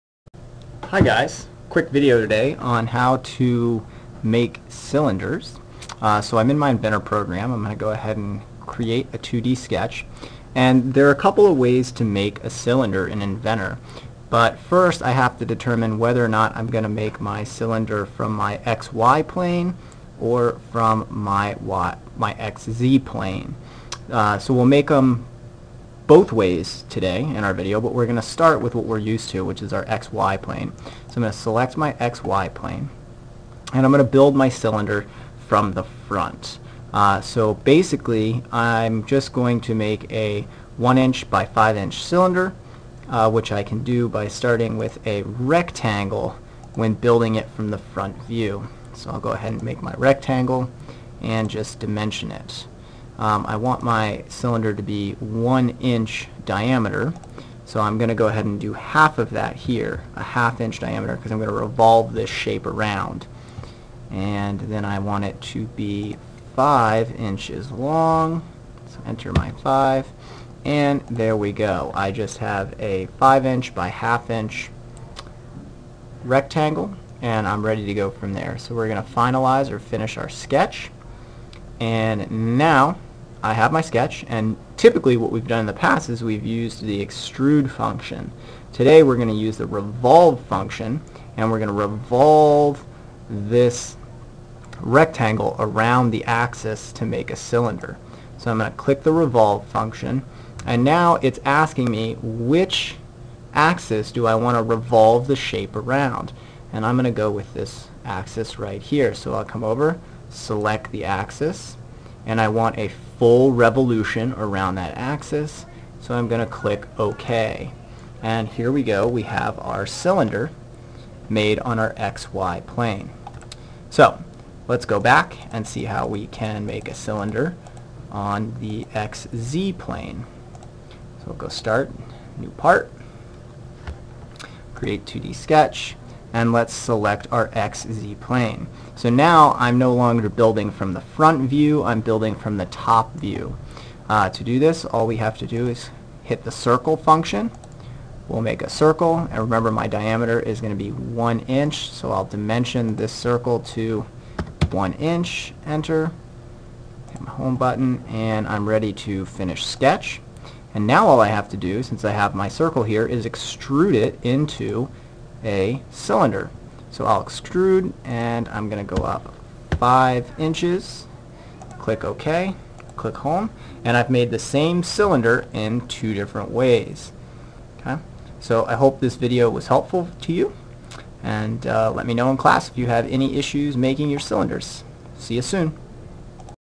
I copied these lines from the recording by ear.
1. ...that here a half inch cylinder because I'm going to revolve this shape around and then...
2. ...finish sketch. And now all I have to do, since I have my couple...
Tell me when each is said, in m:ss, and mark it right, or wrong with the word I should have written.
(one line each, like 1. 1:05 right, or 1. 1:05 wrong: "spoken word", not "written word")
1. 0:59 wrong: "diameter", not "cylinder"
2. 2:39 wrong: "circle", not "couple".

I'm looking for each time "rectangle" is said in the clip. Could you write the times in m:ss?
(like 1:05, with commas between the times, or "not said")
0:45, 0:49, 1:16, 1:34.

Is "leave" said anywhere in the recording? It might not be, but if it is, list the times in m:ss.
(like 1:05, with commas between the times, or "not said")
not said.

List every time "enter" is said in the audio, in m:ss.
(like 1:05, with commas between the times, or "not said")
1:09, 2:35.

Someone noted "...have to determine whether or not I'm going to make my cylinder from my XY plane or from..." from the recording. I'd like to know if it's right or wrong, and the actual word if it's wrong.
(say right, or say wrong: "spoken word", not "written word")
right.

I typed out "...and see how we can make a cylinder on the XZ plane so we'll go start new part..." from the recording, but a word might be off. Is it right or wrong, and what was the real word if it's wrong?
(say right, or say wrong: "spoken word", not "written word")
right.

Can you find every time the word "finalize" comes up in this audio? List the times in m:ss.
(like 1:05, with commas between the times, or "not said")
1:19.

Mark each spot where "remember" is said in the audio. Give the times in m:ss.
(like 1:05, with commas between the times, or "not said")
2:29.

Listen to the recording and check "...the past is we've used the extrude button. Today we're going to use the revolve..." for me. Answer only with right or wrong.
wrong.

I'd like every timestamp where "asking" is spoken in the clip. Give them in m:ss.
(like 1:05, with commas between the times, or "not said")
1:41.